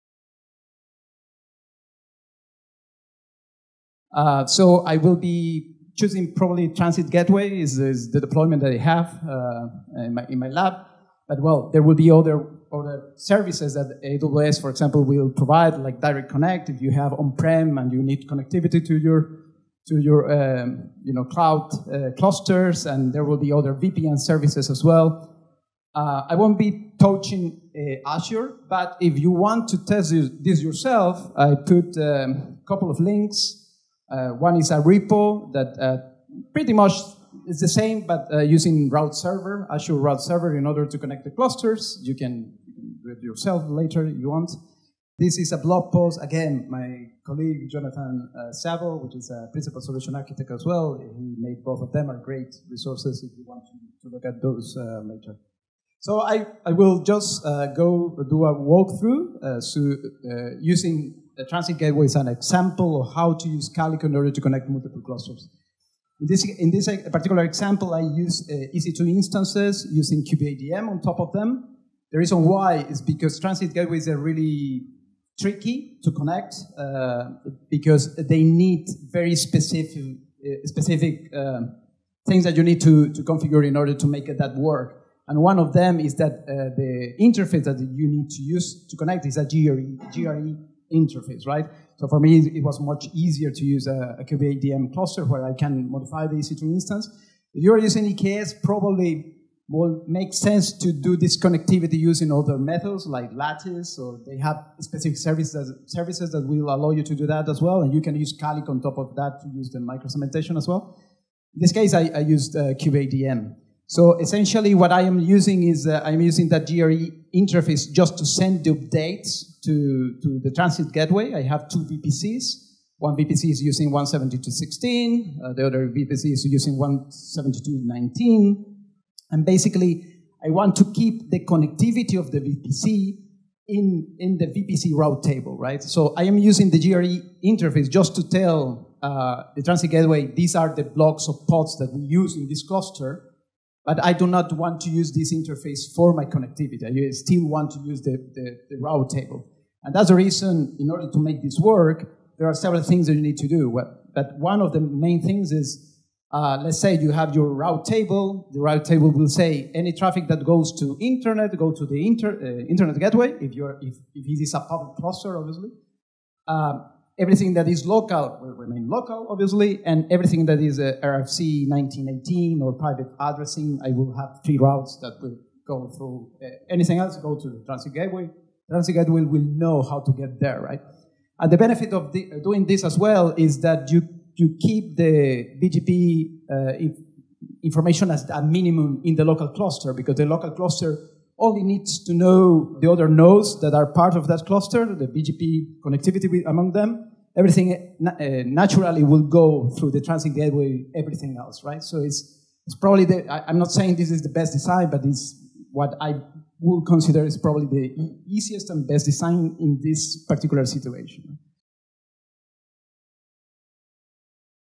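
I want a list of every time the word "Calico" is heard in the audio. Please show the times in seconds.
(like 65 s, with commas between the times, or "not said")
63 s, 108 s.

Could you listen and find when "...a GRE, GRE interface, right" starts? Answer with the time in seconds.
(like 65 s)
89 s.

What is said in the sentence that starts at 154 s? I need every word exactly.
But one of the main things is, uh, let's say you have your route table.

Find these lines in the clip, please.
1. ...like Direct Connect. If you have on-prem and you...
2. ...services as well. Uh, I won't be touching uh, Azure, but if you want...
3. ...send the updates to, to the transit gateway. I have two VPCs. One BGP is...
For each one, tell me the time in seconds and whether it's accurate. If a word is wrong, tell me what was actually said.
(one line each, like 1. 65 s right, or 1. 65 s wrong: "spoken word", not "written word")
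1. 15 s right
2. 24 s right
3. 118 s wrong: "VPC", not "BGP".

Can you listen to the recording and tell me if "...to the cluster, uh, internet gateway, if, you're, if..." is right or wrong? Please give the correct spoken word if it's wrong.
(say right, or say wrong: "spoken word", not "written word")
wrong: "inter", not "cluster".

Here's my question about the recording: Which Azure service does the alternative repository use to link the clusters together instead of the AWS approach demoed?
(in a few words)
Azure Route Server.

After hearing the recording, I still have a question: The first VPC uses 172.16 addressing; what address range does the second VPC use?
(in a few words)
172.19.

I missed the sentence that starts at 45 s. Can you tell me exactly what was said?
This is a blog post, again, my colleague Jonathan uh, Savo, which is a principal solution architect as well.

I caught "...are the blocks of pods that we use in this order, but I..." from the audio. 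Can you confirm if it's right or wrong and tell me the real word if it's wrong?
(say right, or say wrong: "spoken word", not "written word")
wrong: "cluster", not "order".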